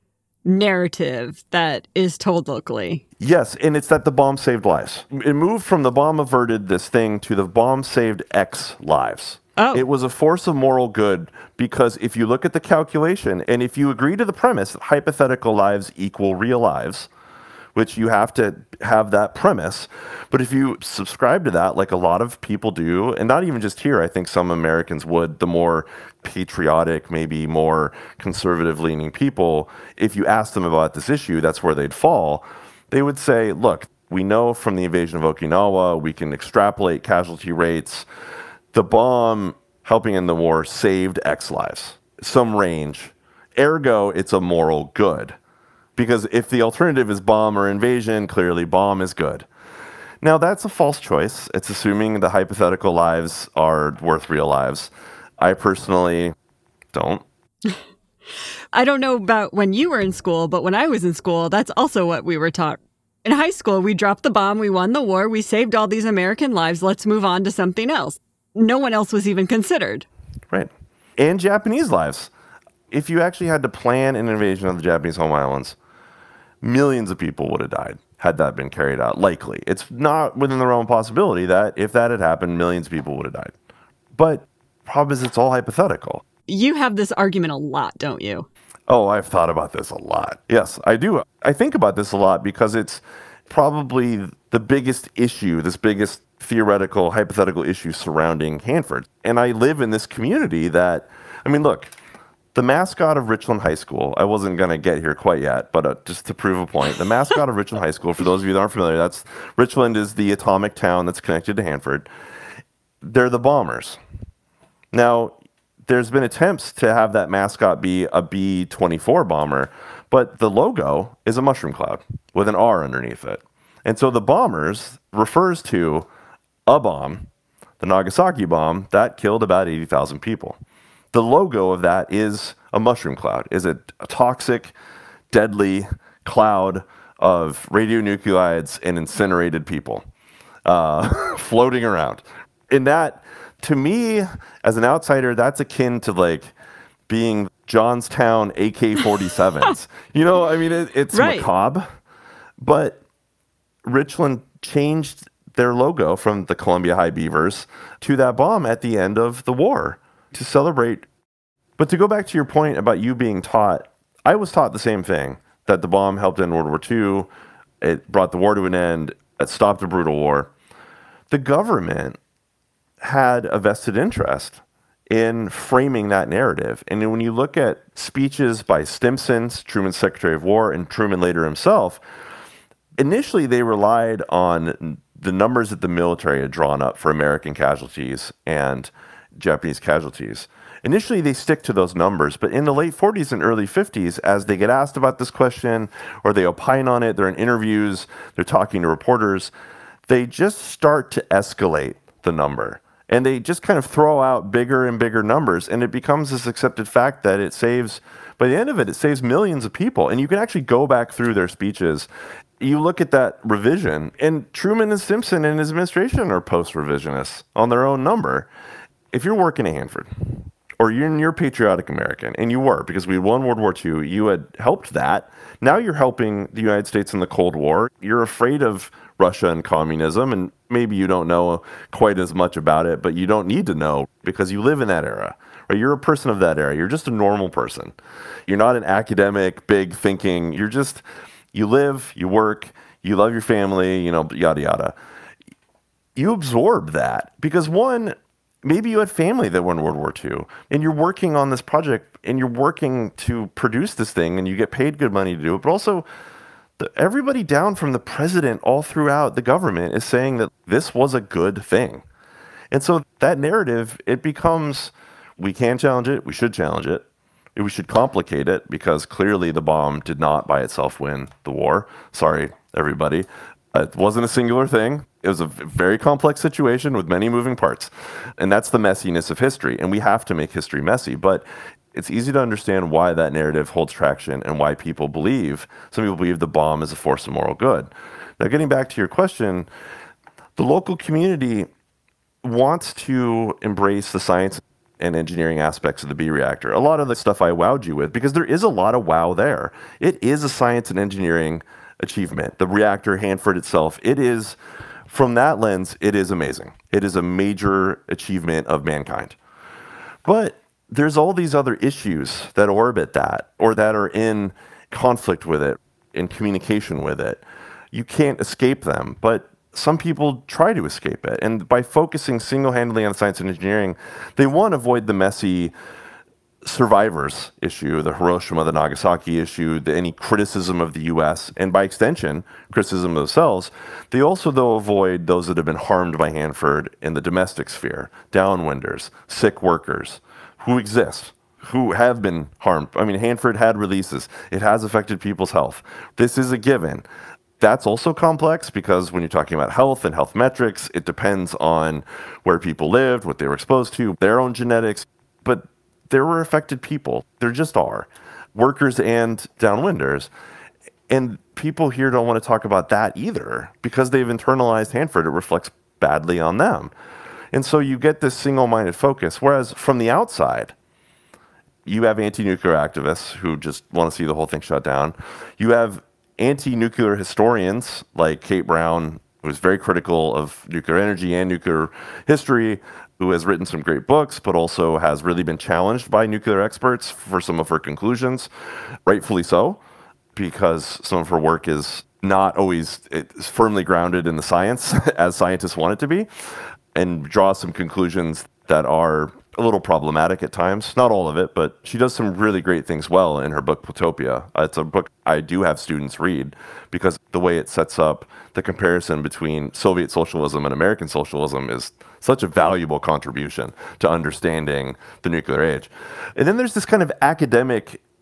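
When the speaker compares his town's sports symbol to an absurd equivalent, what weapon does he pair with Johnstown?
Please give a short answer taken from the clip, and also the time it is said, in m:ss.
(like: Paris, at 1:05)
AK 47s, at 2:28.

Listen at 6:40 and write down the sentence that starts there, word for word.
Not all of it, but she does some really great things well in her book Plutopia.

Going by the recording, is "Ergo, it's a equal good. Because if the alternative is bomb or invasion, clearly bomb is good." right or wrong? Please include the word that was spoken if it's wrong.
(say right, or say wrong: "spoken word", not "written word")
wrong: "moral", not "equal".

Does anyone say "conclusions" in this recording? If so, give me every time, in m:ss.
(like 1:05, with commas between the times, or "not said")
6:27, 6:37.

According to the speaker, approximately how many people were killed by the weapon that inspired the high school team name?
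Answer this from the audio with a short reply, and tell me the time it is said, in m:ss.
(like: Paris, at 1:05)
80,000, at 2:09.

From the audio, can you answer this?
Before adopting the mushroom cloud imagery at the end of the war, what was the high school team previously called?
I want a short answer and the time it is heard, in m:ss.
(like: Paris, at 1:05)
Columbia High Beavers, at 2:36.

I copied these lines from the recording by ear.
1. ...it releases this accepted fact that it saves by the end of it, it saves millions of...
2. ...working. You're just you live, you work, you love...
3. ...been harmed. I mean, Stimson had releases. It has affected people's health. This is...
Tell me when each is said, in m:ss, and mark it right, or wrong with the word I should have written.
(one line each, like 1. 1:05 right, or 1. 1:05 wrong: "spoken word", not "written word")
1. 3:25 wrong: "becomes", not "releases"
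2. 3:59 wrong: "thinking", not "working"
3. 5:42 wrong: "Hanford", not "Stimson".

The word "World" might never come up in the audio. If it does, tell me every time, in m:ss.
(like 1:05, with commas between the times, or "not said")
2:46, 3:43, 4:09.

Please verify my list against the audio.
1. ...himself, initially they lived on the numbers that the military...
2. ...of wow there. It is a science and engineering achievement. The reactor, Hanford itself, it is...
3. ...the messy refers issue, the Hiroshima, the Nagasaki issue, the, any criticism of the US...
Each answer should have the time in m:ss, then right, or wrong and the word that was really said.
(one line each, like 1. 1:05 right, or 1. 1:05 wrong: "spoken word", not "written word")
1. 3:01 wrong: "relied", not "lived"
2. 4:58 right
3. 5:25 wrong: "survivors", not "refers".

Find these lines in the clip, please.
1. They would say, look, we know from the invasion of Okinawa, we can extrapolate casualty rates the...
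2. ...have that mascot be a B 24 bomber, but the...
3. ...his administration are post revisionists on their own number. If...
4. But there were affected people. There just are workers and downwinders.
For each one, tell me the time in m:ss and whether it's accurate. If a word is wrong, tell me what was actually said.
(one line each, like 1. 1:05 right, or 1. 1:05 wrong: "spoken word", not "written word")
1. 0:32 right
2. 1:56 right
3. 3:35 right
4. 5:55 right.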